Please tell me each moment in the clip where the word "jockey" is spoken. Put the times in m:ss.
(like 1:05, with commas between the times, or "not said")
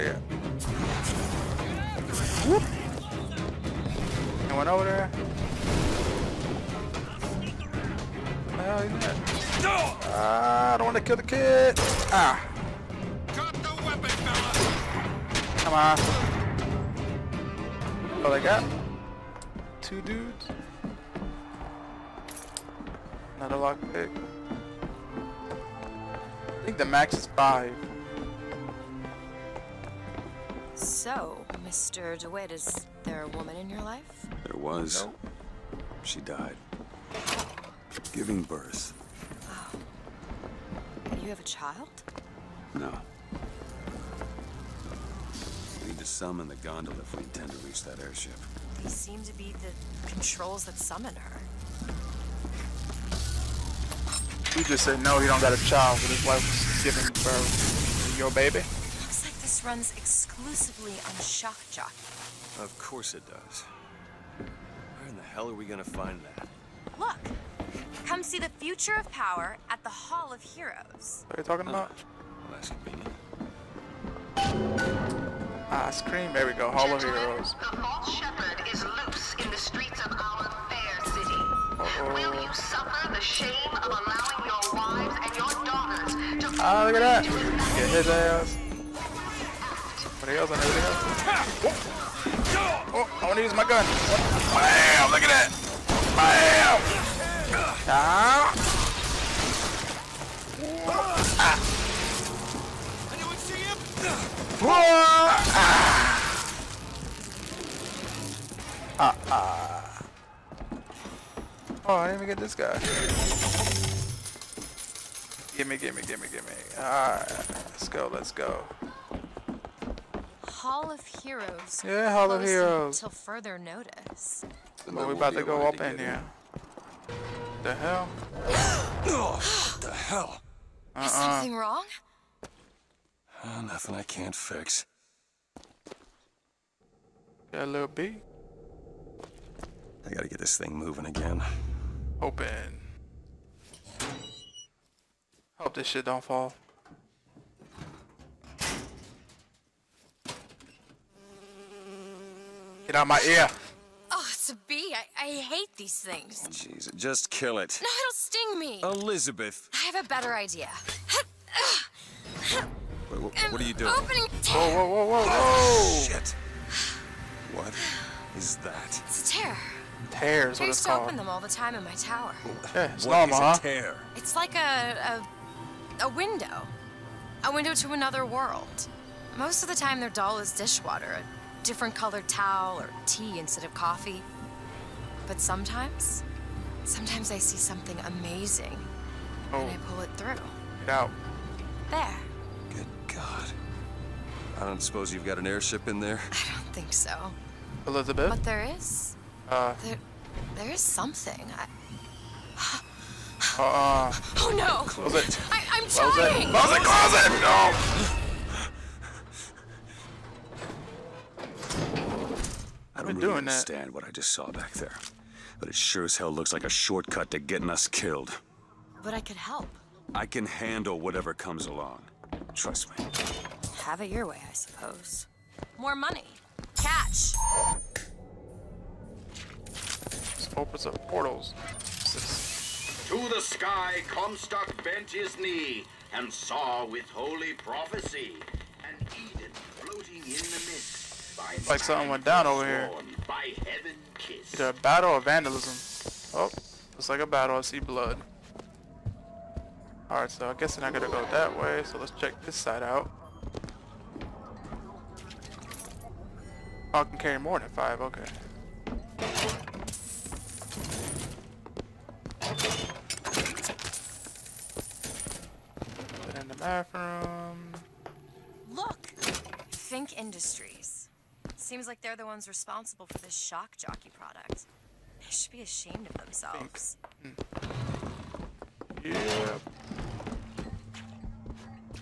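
1:01, 4:33.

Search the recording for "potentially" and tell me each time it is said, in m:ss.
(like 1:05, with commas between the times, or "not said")
not said.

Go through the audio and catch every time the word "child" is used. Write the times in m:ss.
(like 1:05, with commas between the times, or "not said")
0:41, 0:55.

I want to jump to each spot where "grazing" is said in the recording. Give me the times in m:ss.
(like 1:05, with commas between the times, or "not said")
not said.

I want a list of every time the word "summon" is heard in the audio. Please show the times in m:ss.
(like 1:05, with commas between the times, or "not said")
0:46, 0:50.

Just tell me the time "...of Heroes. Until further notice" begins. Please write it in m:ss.
2:02.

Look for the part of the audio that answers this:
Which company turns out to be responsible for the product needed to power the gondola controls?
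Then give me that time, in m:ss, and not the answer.
4:29.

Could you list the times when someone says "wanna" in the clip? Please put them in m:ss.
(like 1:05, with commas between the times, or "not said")
1:33.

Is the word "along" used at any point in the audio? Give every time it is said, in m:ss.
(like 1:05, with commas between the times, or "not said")
3:41.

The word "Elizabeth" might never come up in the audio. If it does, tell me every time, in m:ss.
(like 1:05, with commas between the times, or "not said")
2:39, 3:17.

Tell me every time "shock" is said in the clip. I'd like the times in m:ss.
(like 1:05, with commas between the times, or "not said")
1:01, 4:33.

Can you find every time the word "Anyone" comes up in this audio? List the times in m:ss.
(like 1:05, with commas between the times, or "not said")
0:04, 1:43.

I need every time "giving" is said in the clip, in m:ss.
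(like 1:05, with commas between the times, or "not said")
0:38, 0:56.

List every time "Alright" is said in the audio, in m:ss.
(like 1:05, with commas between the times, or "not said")
1:56, 4:10.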